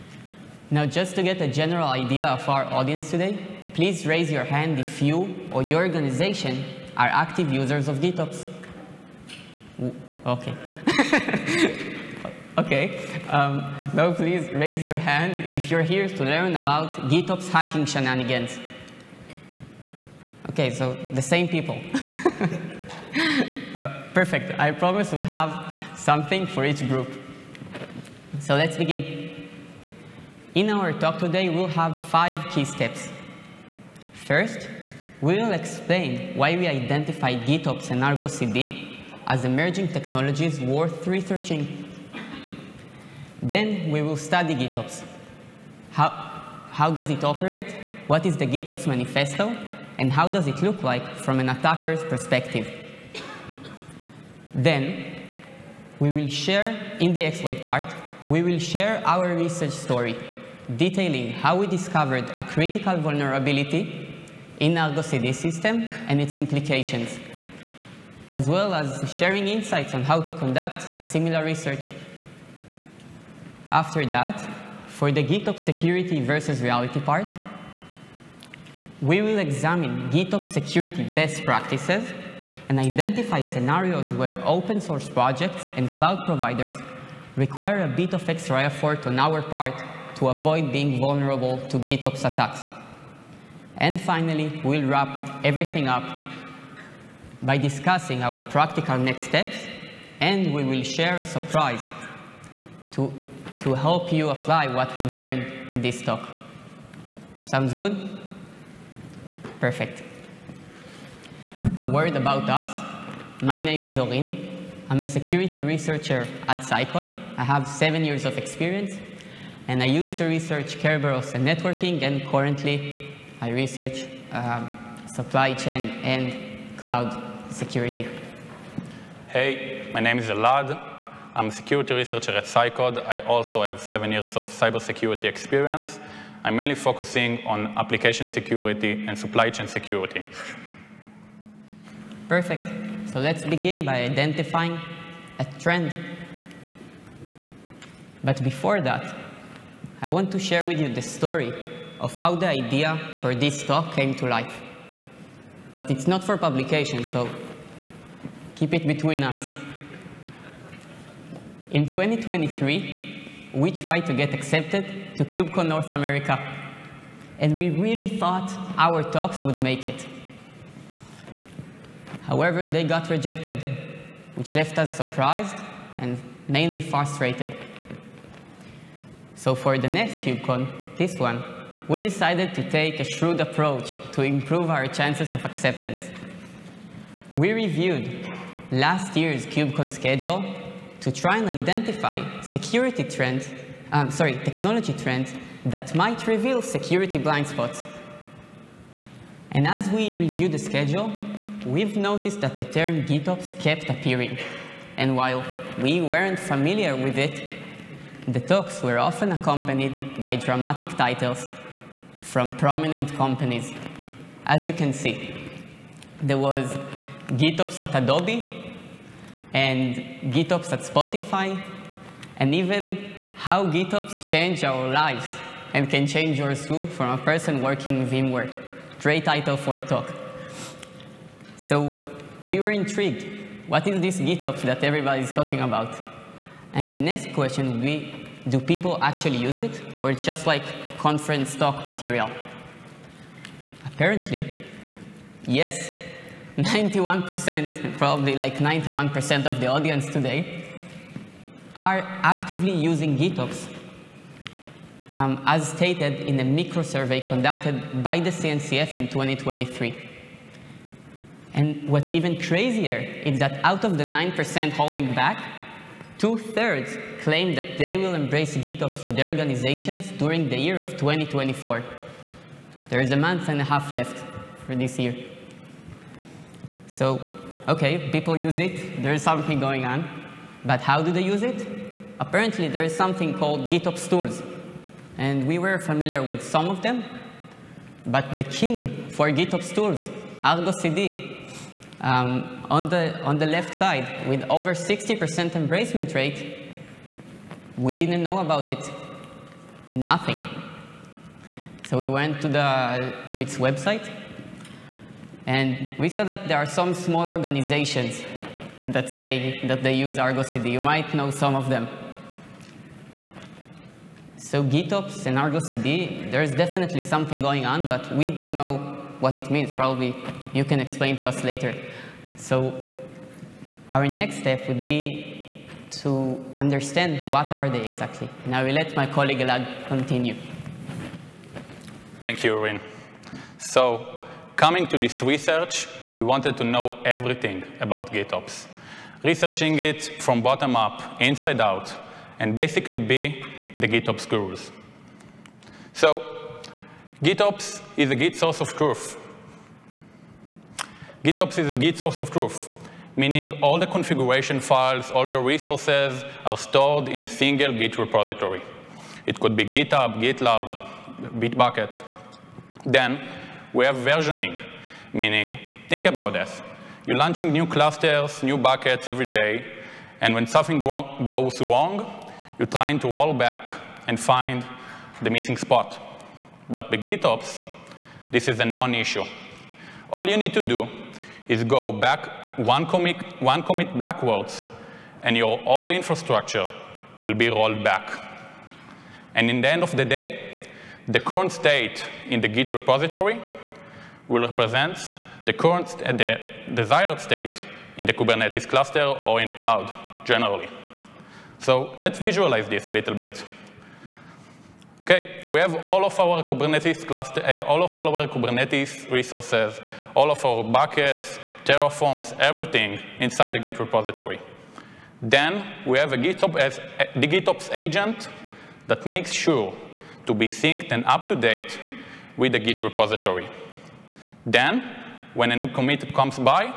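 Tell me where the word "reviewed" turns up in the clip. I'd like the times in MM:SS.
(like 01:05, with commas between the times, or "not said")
03:07, 03:20.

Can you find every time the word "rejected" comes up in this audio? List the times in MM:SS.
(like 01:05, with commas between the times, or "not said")
02:53.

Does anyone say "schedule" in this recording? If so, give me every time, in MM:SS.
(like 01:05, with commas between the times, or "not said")
03:09, 03:20.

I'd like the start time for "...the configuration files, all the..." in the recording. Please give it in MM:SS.
05:53.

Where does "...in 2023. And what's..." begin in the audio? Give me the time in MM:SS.
04:18.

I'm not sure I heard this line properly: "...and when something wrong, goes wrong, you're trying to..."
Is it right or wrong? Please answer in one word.
right.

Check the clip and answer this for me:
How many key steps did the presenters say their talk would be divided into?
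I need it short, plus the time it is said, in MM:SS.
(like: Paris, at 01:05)
5, at 00:32.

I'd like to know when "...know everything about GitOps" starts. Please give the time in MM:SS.
05:36.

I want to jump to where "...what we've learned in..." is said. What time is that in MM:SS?
01:44.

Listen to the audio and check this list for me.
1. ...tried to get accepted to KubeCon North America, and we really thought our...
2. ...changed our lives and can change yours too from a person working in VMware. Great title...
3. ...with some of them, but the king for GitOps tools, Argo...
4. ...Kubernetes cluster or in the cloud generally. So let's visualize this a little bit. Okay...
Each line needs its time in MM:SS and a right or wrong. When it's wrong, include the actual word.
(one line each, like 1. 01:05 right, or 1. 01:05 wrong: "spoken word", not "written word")
1. 02:43 right
2. 03:44 right
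3. 04:46 right
4. 06:38 right.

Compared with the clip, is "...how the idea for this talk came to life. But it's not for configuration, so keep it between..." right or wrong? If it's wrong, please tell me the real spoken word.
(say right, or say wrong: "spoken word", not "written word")
wrong: "publication", not "configuration".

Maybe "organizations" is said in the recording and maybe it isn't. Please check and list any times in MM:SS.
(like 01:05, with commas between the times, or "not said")
00:05, 04:29, 05:07.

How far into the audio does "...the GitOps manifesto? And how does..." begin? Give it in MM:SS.
00:48.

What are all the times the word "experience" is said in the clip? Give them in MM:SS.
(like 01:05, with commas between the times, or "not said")
01:58, 02:15.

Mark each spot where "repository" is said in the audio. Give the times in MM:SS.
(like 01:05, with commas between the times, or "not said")
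05:57, 06:32, 06:53, 07:02.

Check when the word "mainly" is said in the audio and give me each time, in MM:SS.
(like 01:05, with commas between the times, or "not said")
02:16, 02:56.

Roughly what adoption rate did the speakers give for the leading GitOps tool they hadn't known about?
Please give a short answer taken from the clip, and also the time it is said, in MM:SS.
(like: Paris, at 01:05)
over 60%, at 04:54.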